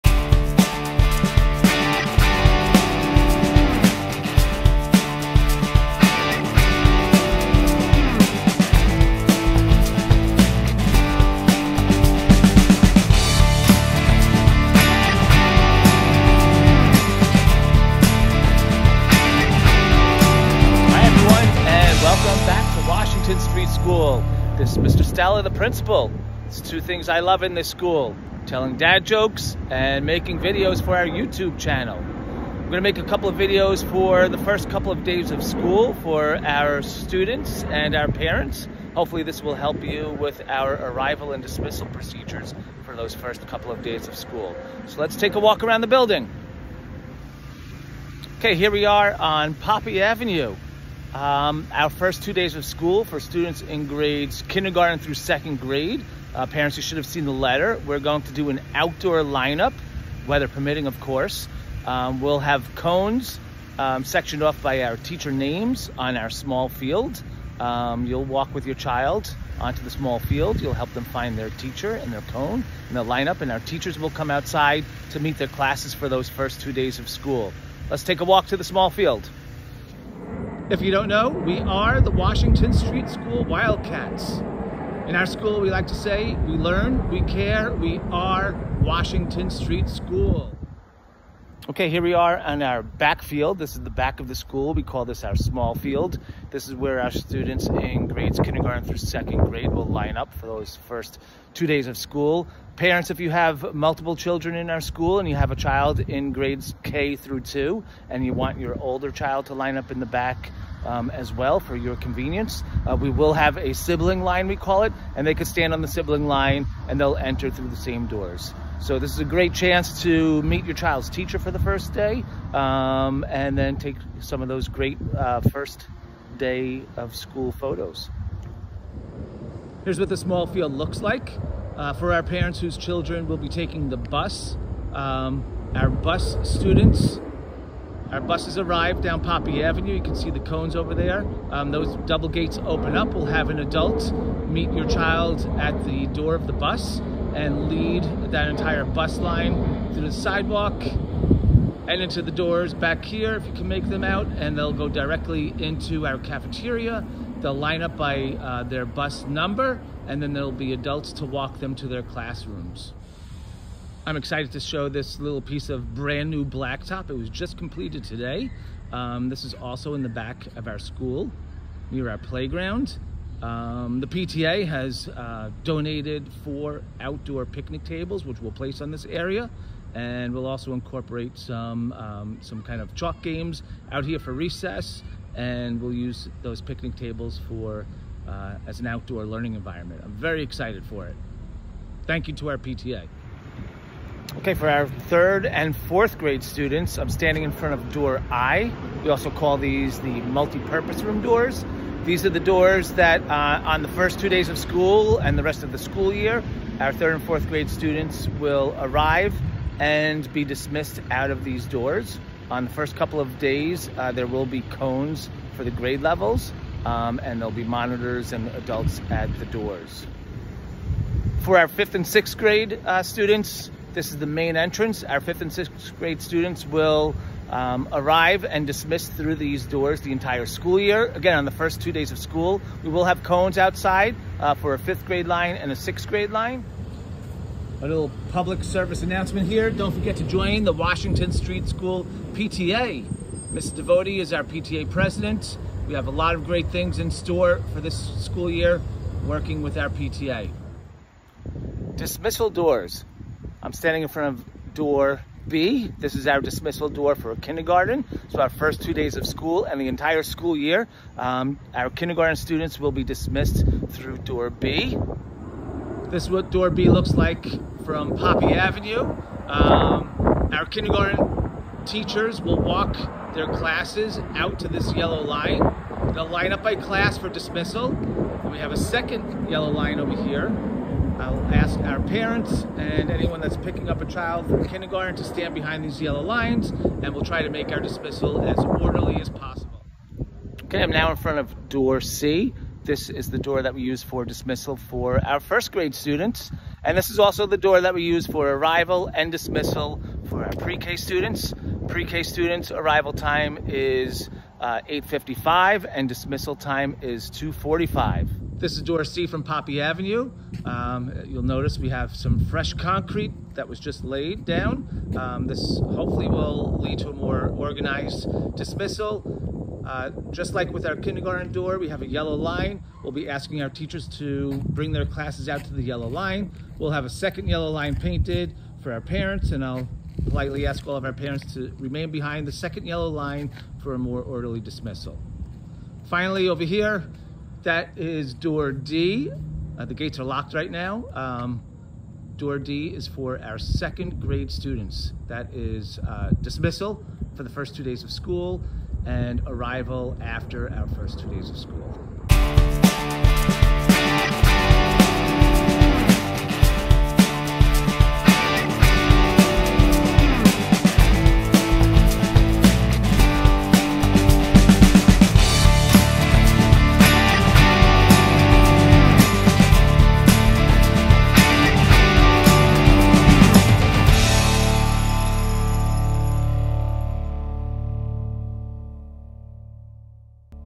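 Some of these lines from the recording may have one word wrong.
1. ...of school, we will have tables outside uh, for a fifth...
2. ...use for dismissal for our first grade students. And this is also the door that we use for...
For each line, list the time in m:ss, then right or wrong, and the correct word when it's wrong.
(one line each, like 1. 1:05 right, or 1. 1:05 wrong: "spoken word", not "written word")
1. 3:52 wrong: "cones", not "tables"
2. 4:53 right.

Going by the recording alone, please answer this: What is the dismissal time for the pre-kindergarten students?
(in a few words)
2:45.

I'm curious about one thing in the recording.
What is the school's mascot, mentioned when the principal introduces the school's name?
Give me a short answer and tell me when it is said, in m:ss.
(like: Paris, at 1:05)
Wildcats, at 1:23.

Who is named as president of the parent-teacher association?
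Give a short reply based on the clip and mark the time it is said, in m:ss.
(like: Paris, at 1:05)
Ms. Devotee, at 4:03.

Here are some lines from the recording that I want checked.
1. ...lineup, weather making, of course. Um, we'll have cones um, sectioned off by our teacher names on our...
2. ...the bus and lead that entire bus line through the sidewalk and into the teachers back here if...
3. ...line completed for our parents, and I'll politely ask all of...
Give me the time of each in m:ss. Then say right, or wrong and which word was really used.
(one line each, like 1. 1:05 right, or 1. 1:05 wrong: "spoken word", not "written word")
1. 0:59 wrong: "permitting", not "making"
2. 2:26 wrong: "doors", not "teachers"
3. 5:27 wrong: "painted", not "completed".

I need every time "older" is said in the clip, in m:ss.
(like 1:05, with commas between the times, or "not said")
1:48.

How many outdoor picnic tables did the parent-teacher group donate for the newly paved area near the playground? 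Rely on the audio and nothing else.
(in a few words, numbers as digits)
4.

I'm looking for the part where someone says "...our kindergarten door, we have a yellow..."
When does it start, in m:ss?
5:20.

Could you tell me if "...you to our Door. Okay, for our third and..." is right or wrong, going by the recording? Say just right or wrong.
wrong.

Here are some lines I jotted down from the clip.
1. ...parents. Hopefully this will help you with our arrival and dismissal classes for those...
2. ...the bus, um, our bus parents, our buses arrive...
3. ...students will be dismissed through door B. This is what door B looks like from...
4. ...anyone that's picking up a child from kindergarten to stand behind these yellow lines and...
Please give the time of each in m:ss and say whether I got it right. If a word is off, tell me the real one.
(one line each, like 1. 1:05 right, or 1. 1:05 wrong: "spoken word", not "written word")
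1. 0:38 wrong: "procedures", not "classes"
2. 2:13 wrong: "students", not "parents"
3. 4:22 right
4. 4:43 right.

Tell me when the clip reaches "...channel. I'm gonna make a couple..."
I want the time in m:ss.
0:31.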